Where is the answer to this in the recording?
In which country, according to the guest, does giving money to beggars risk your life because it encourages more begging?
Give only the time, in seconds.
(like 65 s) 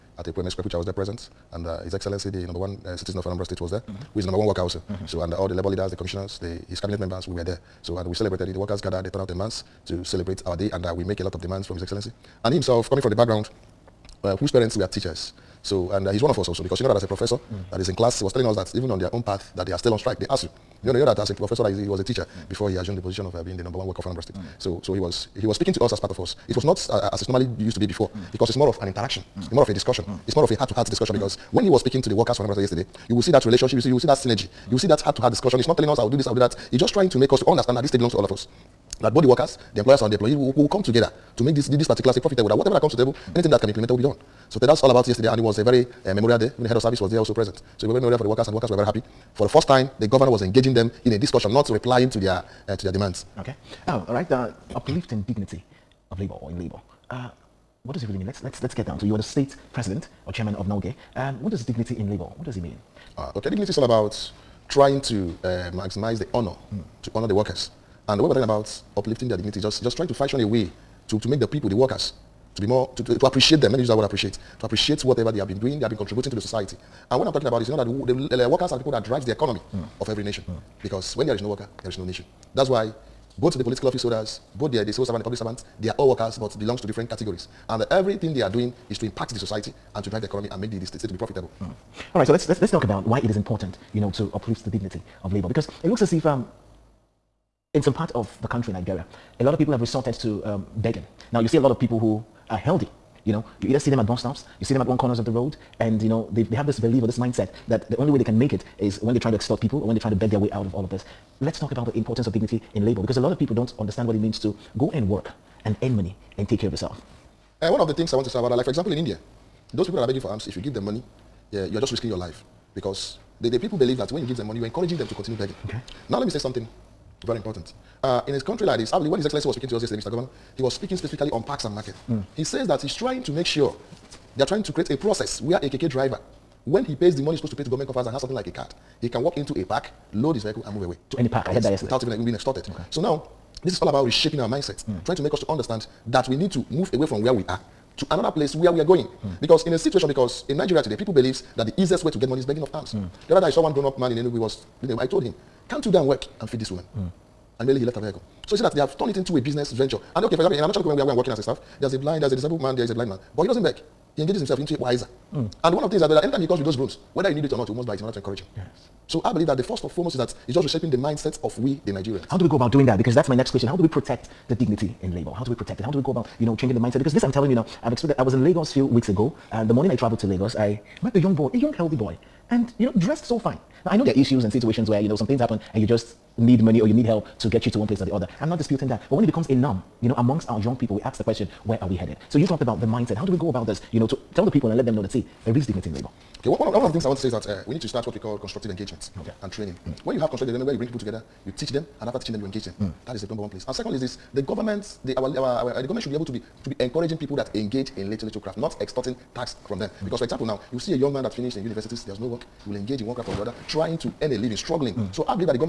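118 s.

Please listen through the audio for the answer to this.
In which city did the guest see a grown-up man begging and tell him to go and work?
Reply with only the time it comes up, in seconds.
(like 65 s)
154 s.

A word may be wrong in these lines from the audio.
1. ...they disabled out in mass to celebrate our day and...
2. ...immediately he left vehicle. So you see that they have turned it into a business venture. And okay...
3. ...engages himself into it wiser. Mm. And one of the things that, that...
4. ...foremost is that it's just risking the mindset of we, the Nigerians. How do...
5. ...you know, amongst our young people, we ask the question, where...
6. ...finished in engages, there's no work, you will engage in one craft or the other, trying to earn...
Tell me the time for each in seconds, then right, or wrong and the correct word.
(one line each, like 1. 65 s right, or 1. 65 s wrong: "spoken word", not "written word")
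1. 9 s wrong: "turned", not "disabled"
2. 157 s right
3. 164 s right
4. 169 s wrong: "reshaping", not "risking"
5. 190 s right
6. 211 s wrong: "universities", not "engages".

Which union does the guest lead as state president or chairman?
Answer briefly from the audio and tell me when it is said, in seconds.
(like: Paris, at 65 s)
NULGE, at 60 s.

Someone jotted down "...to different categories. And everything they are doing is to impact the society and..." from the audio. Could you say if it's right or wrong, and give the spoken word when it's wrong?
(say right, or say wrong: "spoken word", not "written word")
right.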